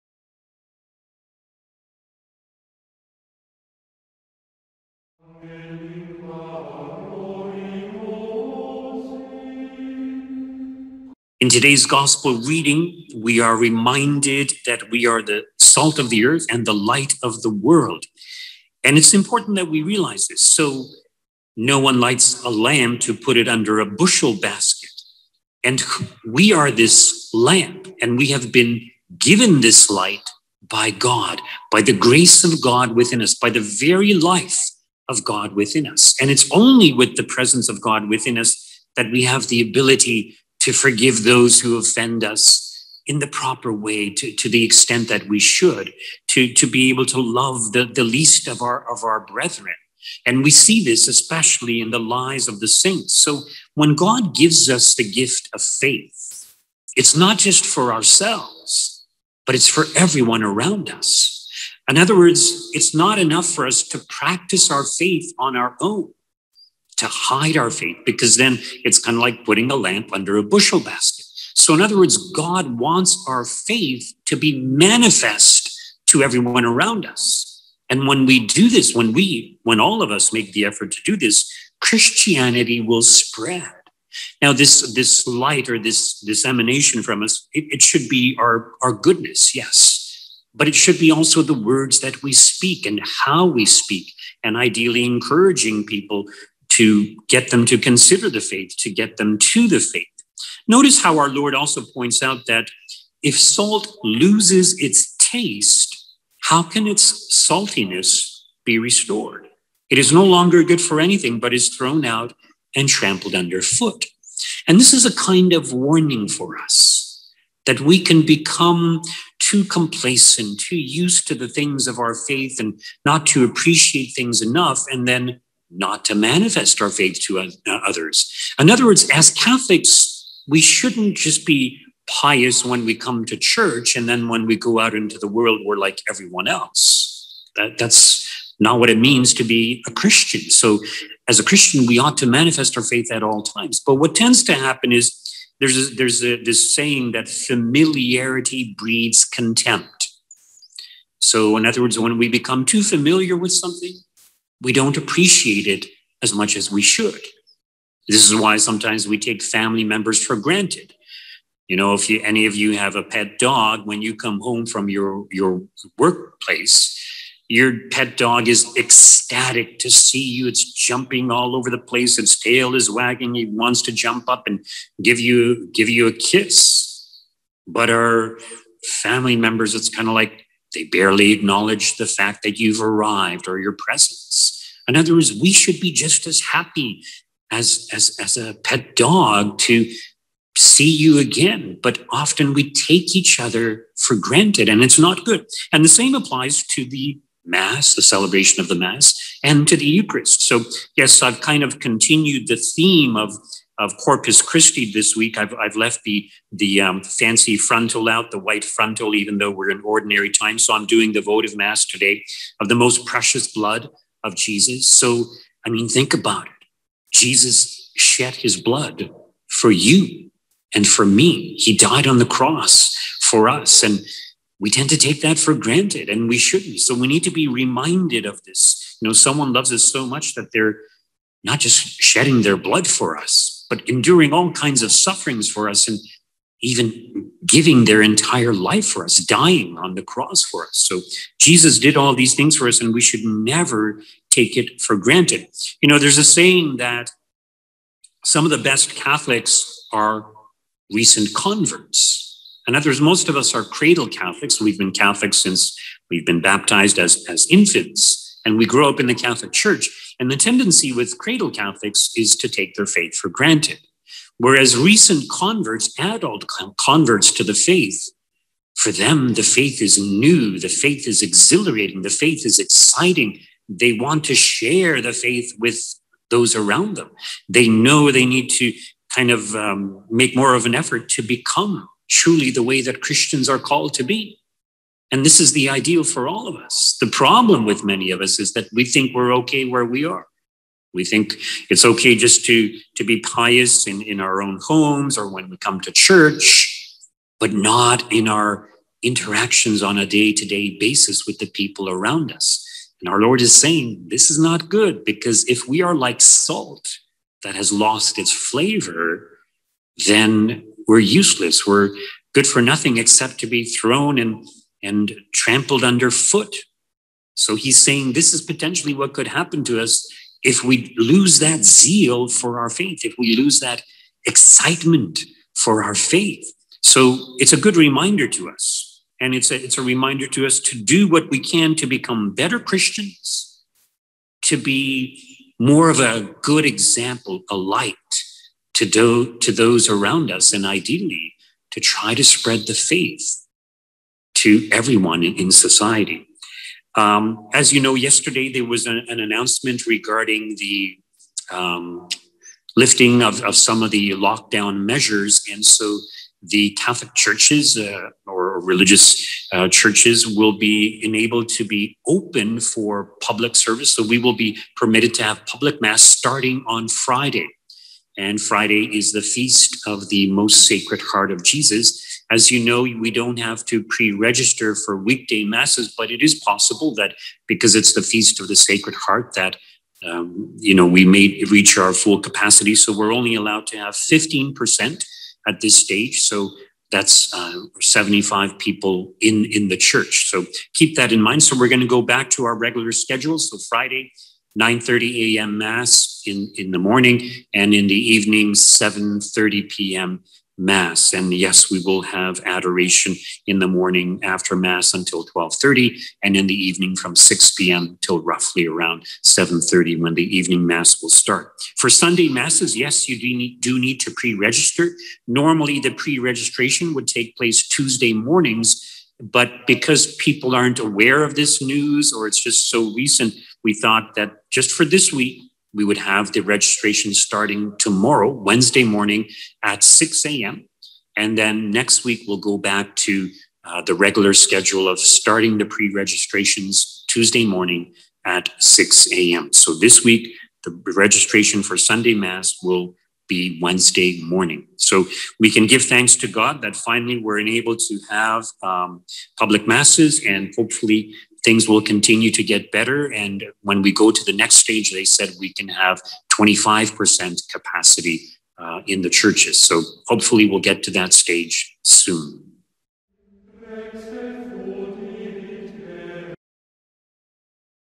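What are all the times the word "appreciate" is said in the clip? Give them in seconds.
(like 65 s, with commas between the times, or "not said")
123 s, 154 s.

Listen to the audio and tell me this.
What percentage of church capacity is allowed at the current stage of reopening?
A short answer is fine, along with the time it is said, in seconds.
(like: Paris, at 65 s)
15%, at 383 s.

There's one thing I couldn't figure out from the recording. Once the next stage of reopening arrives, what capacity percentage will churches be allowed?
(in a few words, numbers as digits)
25%.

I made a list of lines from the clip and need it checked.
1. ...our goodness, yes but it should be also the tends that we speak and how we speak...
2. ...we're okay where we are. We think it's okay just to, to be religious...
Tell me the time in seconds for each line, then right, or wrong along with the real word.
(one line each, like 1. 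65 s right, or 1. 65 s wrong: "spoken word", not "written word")
1. 88 s wrong: "words", not "tends"
2. 289 s wrong: "pious", not "religious".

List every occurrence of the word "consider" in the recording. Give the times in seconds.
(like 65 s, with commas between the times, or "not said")
97 s.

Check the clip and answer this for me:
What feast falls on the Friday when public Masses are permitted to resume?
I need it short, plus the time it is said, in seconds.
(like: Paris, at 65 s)
Most Sacred Heart of Jesus, at 370 s.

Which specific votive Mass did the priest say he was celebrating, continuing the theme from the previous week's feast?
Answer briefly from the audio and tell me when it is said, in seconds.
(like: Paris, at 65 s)
Most Precious Blood of Jesus, at 212 s.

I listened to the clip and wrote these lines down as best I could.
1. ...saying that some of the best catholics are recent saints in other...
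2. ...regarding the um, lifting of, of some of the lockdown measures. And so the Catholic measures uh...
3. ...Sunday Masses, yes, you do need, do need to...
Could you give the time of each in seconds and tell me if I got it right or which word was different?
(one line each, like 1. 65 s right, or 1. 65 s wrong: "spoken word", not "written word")
1. 246 s wrong: "converts", not "saints"
2. 349 s wrong: "churches", not "measures"
3. 411 s right.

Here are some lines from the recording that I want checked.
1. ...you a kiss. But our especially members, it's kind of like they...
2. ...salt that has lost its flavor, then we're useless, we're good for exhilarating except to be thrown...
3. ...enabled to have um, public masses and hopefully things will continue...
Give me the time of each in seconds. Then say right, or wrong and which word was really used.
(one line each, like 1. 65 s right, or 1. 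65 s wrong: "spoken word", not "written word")
1. 175 s wrong: "family", not "especially"
2. 306 s wrong: "nothing", not "exhilarating"
3. 447 s right.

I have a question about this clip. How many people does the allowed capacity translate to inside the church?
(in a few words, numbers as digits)
75.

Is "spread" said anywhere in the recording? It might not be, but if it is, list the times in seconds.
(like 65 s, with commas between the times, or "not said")
83 s, 342 s.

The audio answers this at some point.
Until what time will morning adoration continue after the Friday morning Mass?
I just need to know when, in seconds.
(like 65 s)
405 s.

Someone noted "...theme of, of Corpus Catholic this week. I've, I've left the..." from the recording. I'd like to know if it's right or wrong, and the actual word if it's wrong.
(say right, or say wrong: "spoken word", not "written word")
wrong: "Christi", not "Catholic".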